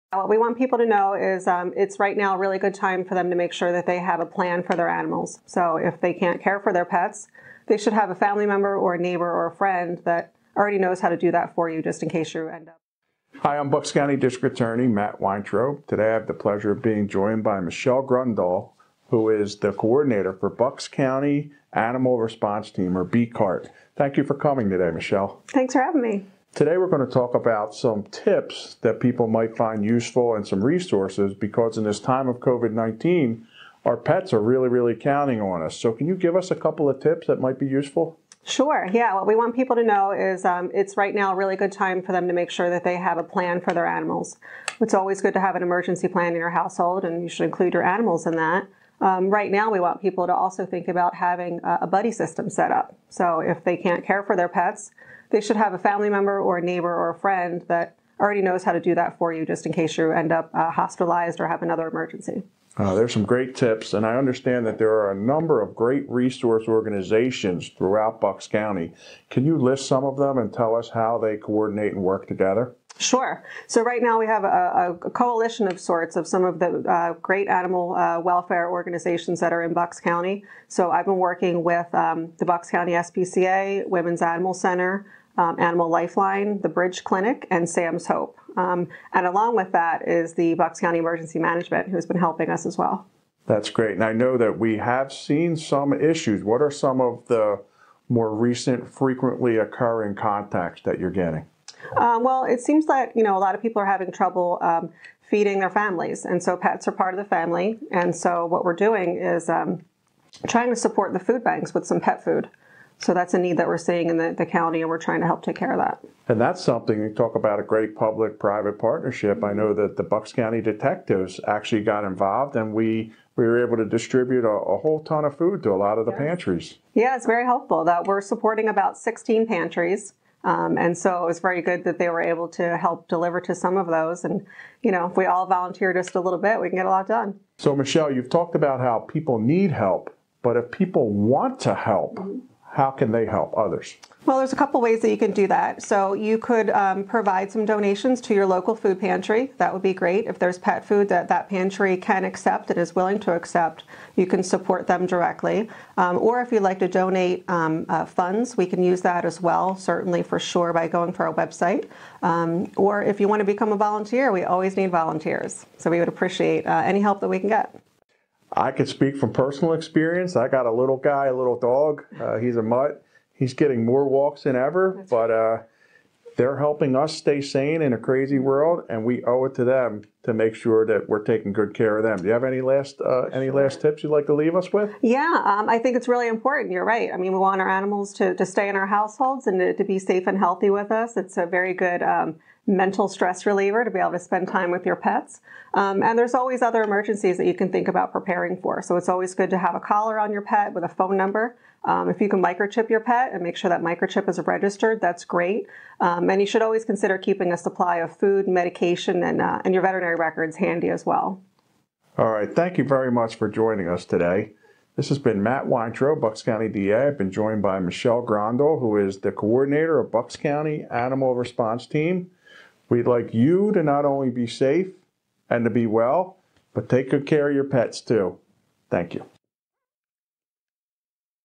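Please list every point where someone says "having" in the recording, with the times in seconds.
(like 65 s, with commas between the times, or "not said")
25 s, 51 s, 103 s.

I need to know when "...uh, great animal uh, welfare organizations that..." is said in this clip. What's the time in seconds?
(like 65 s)
76 s.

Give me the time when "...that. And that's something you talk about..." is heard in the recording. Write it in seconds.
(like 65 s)
115 s.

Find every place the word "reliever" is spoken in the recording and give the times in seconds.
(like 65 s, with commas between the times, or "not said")
193 s.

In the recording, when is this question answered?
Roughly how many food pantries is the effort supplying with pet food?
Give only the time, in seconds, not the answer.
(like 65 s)
128 s.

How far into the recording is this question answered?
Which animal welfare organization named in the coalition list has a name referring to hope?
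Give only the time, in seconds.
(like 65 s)
87 s.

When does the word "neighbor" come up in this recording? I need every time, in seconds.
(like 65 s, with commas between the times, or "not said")
8 s, 56 s.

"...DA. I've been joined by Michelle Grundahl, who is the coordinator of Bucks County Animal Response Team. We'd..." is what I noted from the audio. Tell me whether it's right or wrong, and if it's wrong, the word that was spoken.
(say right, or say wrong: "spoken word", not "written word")
right.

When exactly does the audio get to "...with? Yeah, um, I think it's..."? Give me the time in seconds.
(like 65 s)
184 s.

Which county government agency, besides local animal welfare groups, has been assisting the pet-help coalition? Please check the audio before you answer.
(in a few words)
Bucks County Emergency Management.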